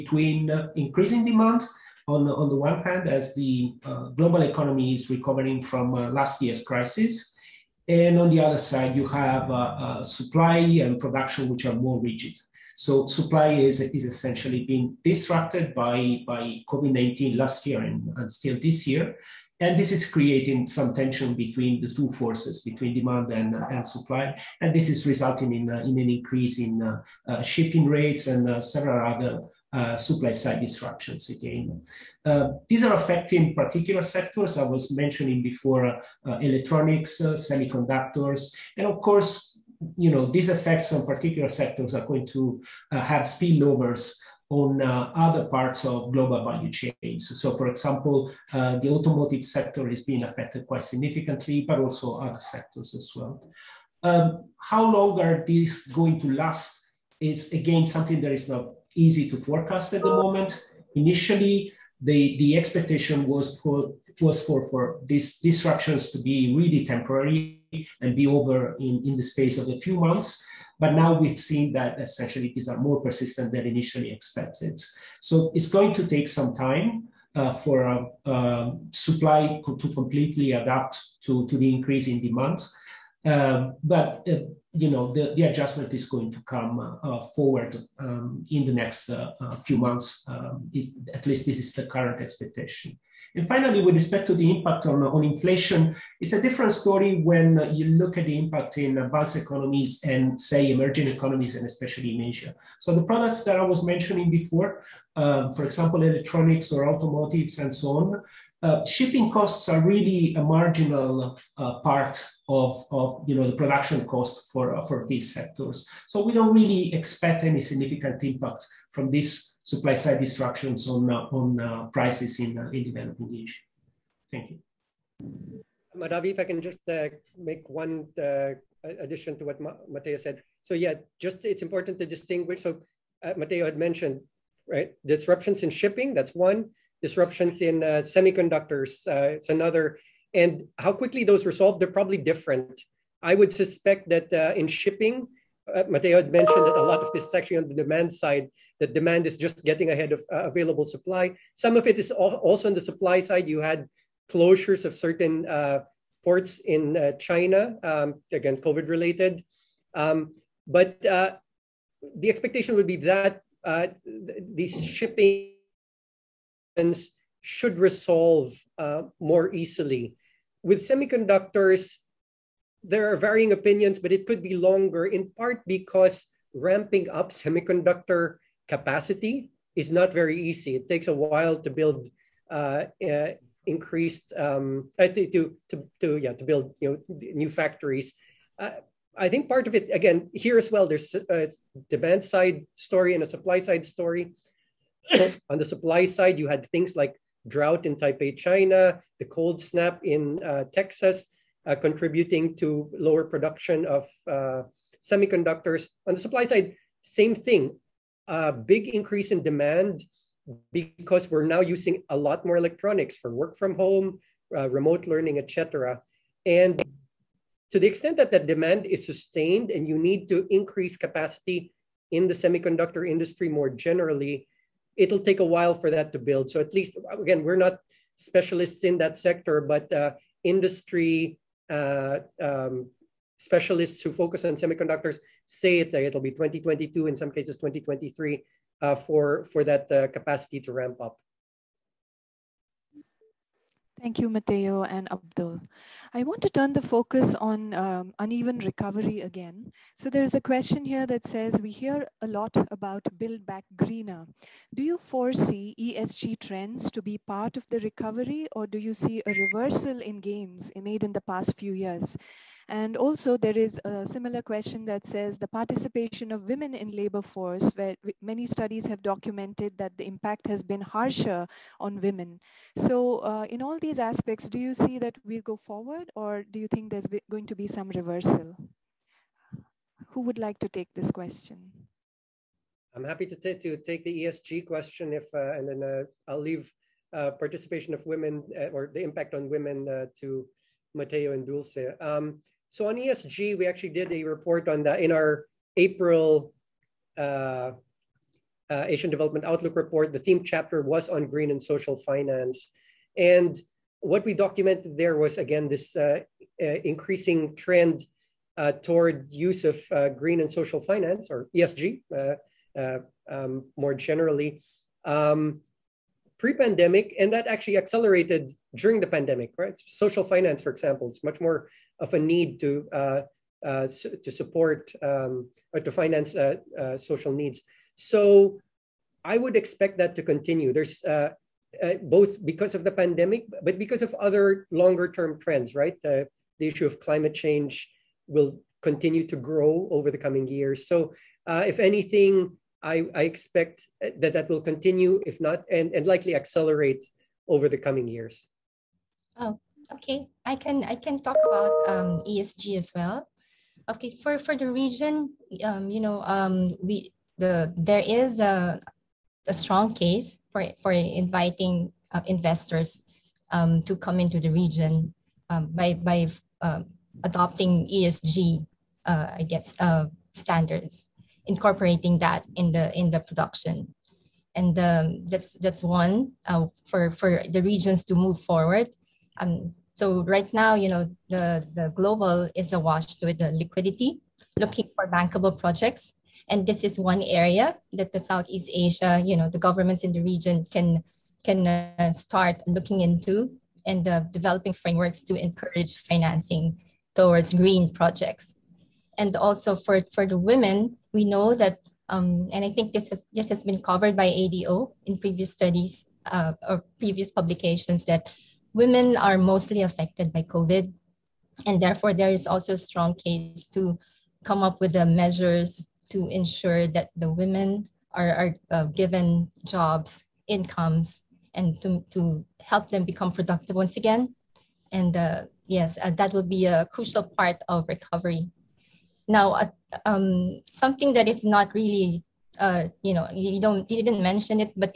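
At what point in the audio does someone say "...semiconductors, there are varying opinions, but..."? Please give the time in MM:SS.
02:50.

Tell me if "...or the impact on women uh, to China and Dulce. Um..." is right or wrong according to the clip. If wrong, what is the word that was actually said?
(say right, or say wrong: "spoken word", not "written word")
wrong: "Matteo", not "China".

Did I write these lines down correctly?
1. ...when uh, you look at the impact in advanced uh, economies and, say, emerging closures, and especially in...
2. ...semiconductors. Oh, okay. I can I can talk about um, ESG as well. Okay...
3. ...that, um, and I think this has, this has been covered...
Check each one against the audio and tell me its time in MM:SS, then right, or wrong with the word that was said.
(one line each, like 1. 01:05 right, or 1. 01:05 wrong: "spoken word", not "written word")
1. 01:37 wrong: "economies", not "closures"
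2. 05:48 wrong: "years", not "semiconductors"
3. 06:41 right.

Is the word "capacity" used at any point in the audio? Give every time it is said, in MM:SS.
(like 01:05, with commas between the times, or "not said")
02:58, 03:40, 04:00.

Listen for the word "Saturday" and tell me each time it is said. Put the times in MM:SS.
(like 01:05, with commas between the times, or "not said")
not said.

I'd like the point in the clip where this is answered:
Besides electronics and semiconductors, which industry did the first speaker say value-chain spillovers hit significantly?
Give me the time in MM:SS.
00:48.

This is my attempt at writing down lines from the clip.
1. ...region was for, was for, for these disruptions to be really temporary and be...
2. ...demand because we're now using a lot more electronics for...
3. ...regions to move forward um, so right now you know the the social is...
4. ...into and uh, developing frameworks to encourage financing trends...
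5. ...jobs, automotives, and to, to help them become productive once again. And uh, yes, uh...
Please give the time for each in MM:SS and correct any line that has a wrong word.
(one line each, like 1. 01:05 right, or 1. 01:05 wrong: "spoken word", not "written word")
1. 01:02 wrong: "expectation", not "region"
2. 03:29 right
3. 06:17 wrong: "global", not "social"
4. 06:32 wrong: "towards", not "trends"
5. 06:59 wrong: "incomes", not "automotives".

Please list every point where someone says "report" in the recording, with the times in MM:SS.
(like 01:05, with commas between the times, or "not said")
04:54, 04:59.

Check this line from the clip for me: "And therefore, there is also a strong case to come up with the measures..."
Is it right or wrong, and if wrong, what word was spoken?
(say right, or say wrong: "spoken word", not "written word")
right.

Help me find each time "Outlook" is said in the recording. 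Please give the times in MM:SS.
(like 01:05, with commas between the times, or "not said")
04:59.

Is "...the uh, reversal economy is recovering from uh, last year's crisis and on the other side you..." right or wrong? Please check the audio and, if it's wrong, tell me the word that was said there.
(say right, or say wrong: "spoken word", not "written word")
wrong: "global", not "reversal".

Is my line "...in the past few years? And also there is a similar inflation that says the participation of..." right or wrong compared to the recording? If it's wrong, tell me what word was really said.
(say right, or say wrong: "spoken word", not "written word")
wrong: "question", not "inflation".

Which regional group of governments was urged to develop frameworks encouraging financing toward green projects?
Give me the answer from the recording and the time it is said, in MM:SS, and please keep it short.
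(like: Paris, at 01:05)
Southeast Asia, at 06:28.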